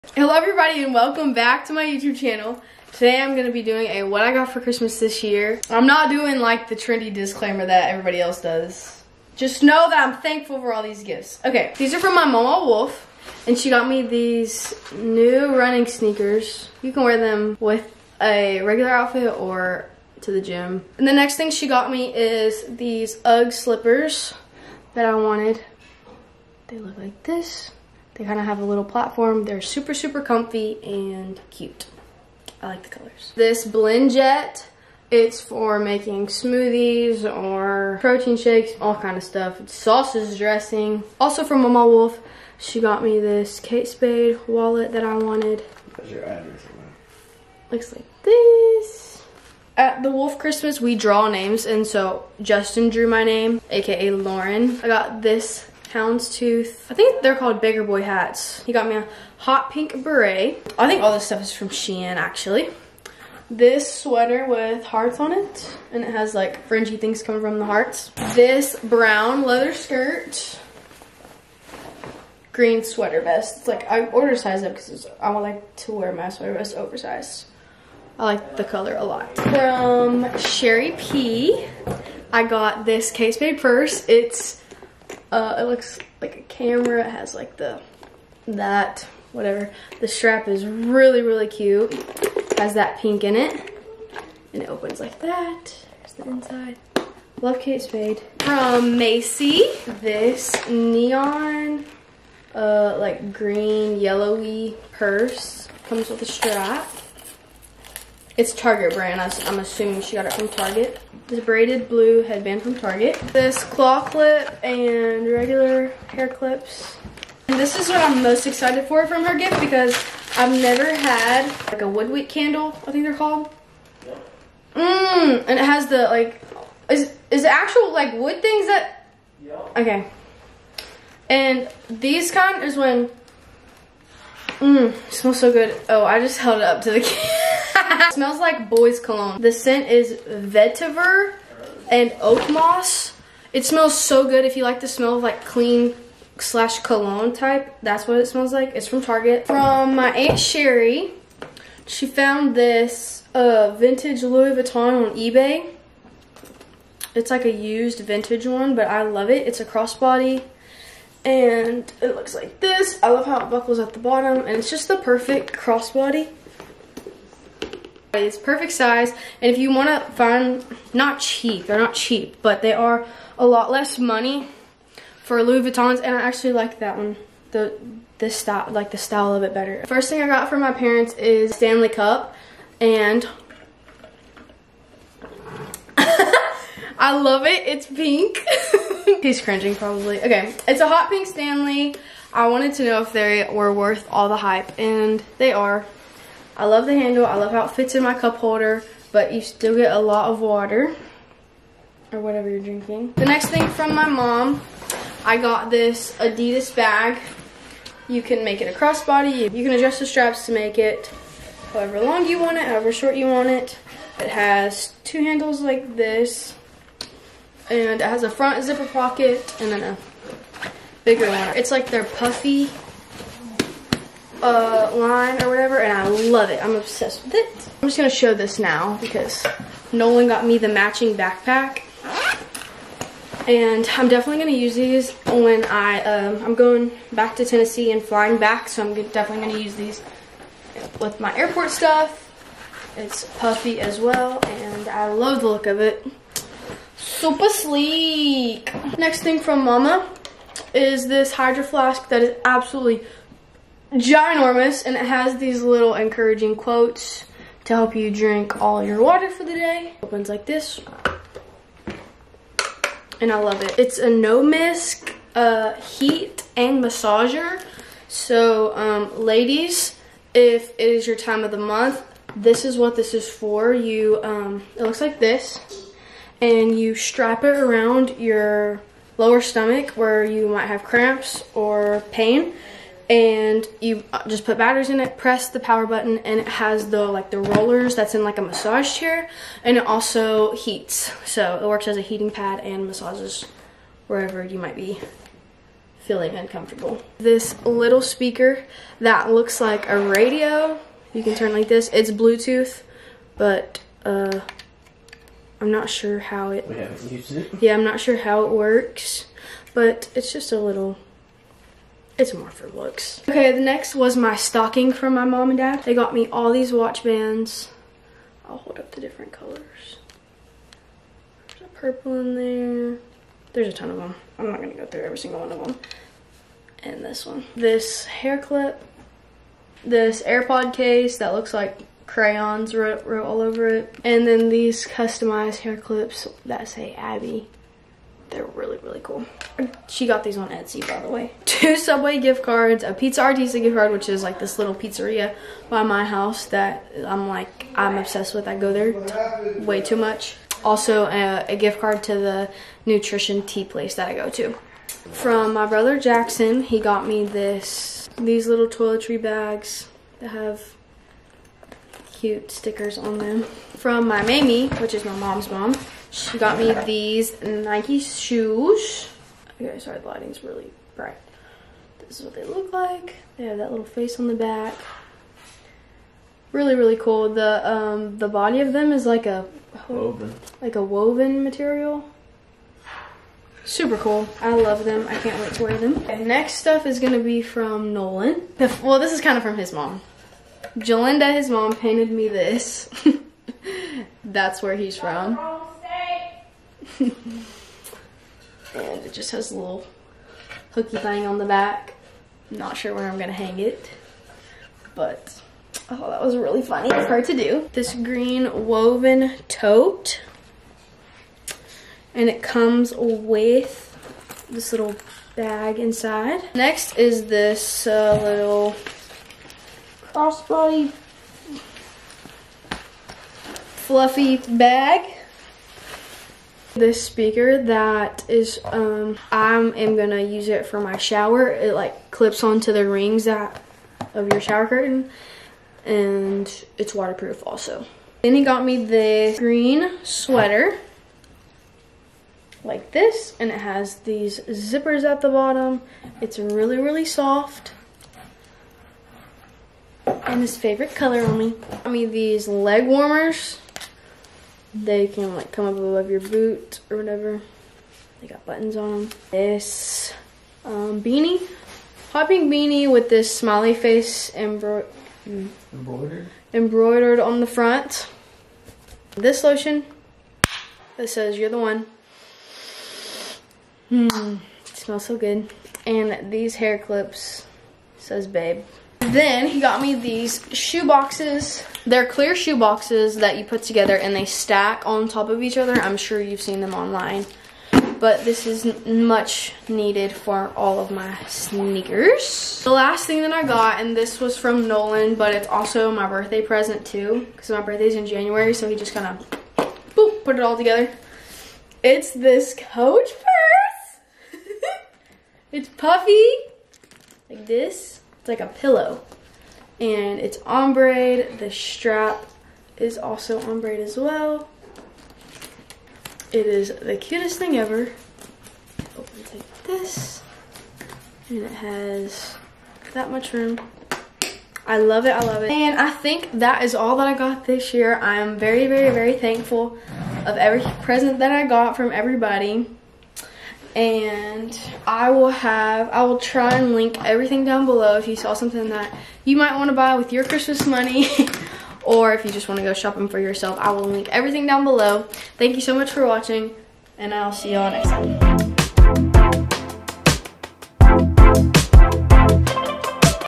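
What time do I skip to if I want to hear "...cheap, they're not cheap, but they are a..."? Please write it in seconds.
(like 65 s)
171 s.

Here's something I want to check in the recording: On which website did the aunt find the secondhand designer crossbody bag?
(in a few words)
eBay.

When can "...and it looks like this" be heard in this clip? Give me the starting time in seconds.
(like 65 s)
161 s.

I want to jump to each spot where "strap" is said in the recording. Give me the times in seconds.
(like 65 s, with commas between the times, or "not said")
90 s, 106 s, 210 s, 276 s, 511 s.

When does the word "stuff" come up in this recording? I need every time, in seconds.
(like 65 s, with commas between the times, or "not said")
39 s, 61 s, 241 s, 386 s.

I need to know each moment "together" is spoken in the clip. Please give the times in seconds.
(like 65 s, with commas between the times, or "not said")
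483 s, 500 s.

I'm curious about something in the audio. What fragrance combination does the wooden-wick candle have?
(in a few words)
Vetiver and oak moss.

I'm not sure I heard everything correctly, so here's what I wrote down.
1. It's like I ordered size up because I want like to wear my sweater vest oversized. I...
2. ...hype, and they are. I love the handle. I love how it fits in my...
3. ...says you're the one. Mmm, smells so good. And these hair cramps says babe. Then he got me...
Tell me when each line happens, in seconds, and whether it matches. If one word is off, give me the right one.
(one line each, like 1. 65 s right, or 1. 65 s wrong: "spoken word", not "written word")
1. 73 s right
2. 194 s right
3. 471 s wrong: "clips", not "cramps".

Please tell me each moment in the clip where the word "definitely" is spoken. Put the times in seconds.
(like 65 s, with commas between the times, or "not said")
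234 s, 239 s.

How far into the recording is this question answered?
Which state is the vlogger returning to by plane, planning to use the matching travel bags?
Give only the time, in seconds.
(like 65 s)
237 s.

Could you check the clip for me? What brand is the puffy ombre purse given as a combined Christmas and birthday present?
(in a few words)
Coach.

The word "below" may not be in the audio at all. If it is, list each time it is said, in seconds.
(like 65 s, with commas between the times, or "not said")
537 s, 544 s.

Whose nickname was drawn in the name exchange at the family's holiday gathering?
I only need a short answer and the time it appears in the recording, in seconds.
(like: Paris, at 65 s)
Justin, at 52 s.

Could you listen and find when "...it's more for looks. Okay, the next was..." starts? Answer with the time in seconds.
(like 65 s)
312 s.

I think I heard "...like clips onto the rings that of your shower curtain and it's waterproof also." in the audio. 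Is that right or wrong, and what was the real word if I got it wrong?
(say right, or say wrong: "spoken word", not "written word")
right.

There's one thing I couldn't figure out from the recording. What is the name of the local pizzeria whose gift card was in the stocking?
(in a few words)
Pizza Artista.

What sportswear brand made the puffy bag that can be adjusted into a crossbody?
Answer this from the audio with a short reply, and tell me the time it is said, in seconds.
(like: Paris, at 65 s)
Adidas, at 206 s.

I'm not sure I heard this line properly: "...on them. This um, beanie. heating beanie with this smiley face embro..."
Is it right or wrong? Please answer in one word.
wrong.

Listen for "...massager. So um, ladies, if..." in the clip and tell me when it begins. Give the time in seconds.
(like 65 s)
266 s.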